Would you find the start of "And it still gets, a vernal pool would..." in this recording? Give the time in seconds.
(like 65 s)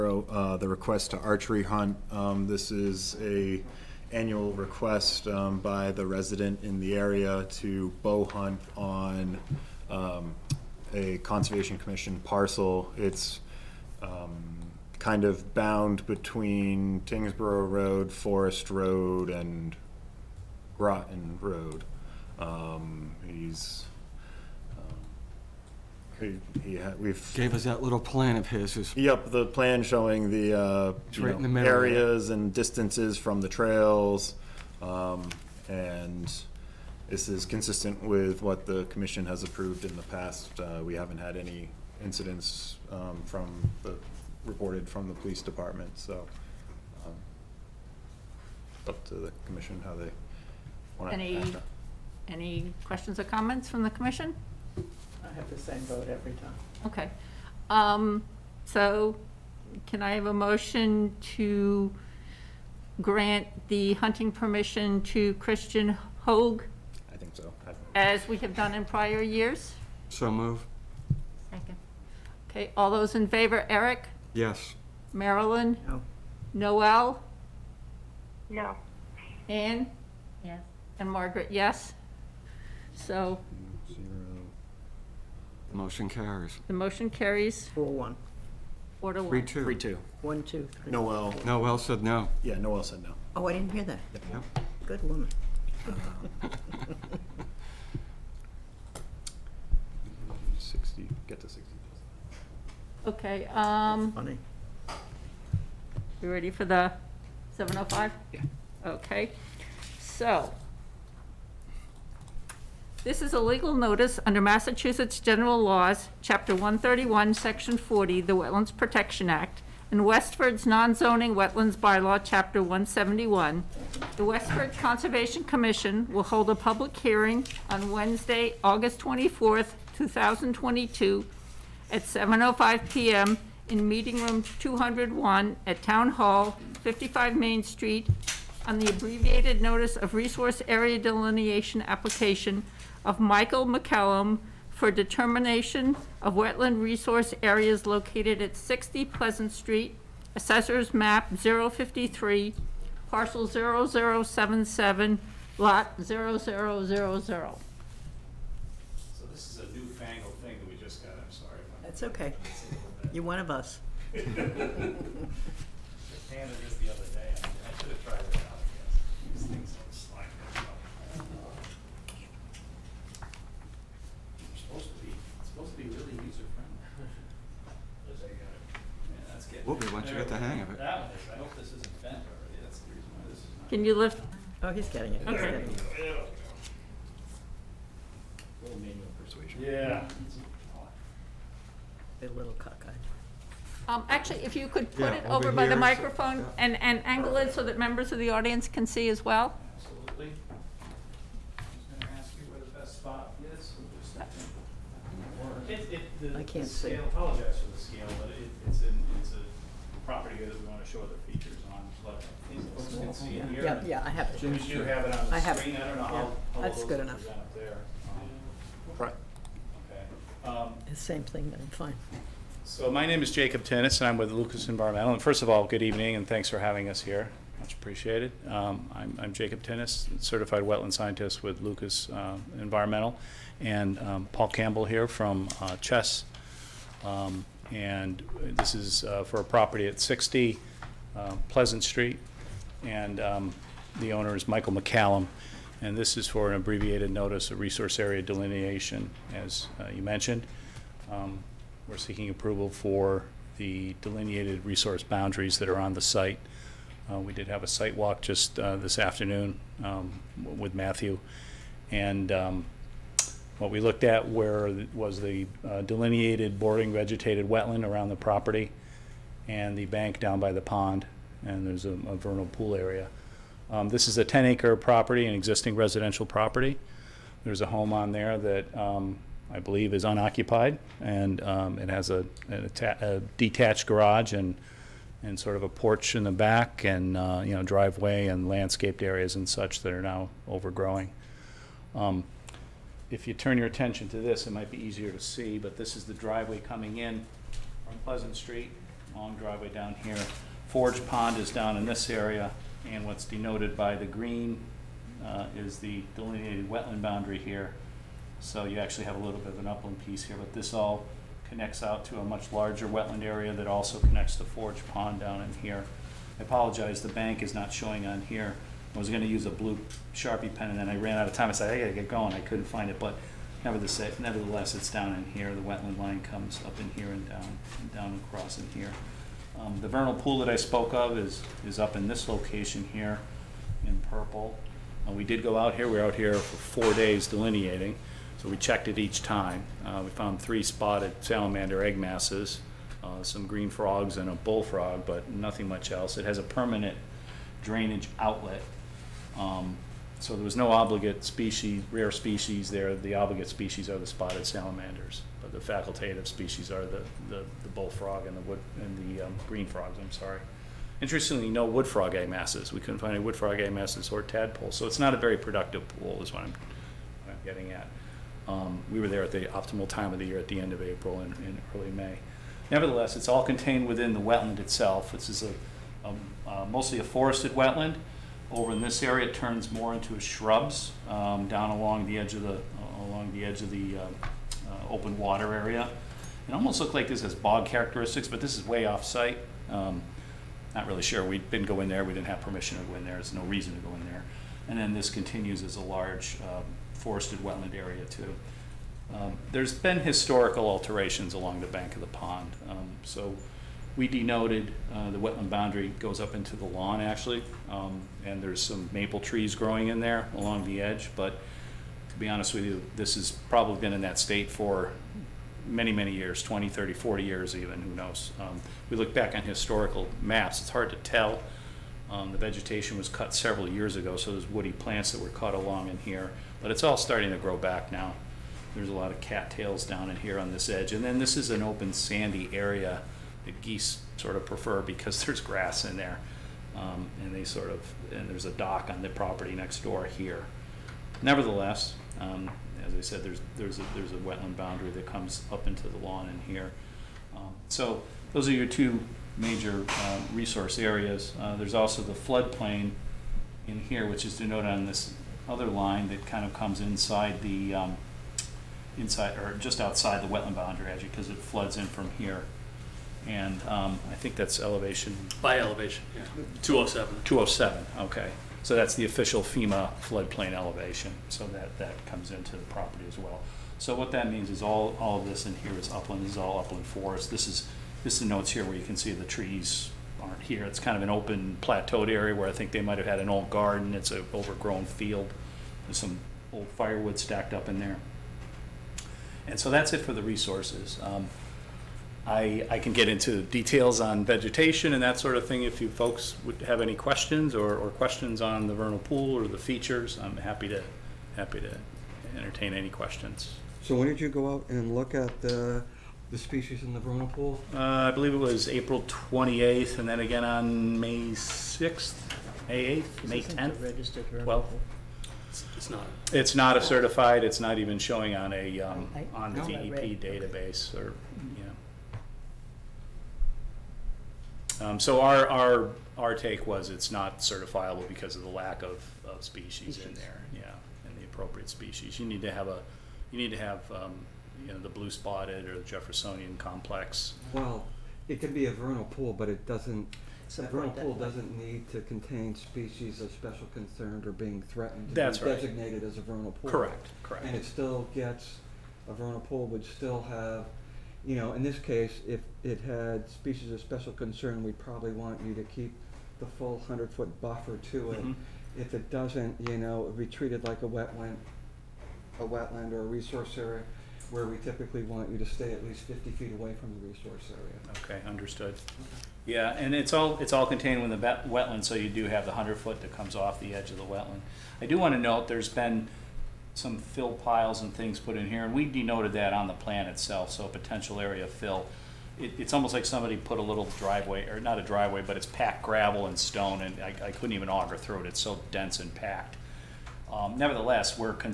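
547 s.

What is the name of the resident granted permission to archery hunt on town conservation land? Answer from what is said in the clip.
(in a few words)
Christian Hoag.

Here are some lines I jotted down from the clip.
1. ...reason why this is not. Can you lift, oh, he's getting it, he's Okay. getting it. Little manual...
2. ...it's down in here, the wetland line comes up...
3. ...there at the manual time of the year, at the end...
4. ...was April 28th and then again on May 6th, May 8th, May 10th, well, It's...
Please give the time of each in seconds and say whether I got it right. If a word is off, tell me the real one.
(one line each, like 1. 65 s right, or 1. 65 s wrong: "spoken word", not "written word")
1. 182 s right
2. 324 s right
3. 369 s wrong: "optimal", not "manual"
4. 508 s right.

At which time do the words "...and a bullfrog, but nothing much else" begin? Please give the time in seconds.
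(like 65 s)
344 s.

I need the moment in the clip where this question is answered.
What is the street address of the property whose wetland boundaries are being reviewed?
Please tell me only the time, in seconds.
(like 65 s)
148 s.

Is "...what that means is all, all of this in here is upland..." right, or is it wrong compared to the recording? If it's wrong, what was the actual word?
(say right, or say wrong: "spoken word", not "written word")
right.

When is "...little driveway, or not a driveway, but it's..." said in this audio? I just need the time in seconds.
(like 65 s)
583 s.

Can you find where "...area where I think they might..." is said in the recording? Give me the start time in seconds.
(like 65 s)
482 s.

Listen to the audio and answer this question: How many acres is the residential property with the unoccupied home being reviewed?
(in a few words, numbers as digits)
10.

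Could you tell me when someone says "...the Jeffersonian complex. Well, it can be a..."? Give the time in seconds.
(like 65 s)
535 s.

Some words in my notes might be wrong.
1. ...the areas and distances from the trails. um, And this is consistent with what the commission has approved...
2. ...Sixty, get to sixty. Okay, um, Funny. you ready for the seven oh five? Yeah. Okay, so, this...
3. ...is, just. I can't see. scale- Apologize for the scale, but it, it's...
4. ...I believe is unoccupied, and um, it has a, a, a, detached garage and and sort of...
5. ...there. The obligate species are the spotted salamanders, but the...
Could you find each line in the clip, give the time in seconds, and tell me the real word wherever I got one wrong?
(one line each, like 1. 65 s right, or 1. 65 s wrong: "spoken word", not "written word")
1. 31 s right
2. 100 s right
3. 203 s right
4. 279 s right
5. 352 s right.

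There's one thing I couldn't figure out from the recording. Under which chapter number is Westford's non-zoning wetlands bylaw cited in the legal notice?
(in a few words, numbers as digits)
171.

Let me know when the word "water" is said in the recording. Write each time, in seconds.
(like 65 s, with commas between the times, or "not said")
385 s.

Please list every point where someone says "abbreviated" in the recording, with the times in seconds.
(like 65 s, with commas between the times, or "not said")
138 s, 246 s.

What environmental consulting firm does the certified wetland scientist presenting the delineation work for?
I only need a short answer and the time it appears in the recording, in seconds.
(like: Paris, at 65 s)
Lucas Environmental, at 224 s.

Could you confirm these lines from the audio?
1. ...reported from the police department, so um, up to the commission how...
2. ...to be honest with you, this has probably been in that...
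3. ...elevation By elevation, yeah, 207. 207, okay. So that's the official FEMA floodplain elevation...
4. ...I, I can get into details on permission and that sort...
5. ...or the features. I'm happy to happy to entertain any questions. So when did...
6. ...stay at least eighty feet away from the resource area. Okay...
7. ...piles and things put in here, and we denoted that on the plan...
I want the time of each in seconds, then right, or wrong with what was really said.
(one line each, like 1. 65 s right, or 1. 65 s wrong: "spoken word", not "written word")
1. 44 s right
2. 412 s right
3. 464 s right
4. 492 s wrong: "vegetation", not "permission"
5. 499 s right
6. 565 s wrong: "fifty", not "eighty"
7. 577 s right.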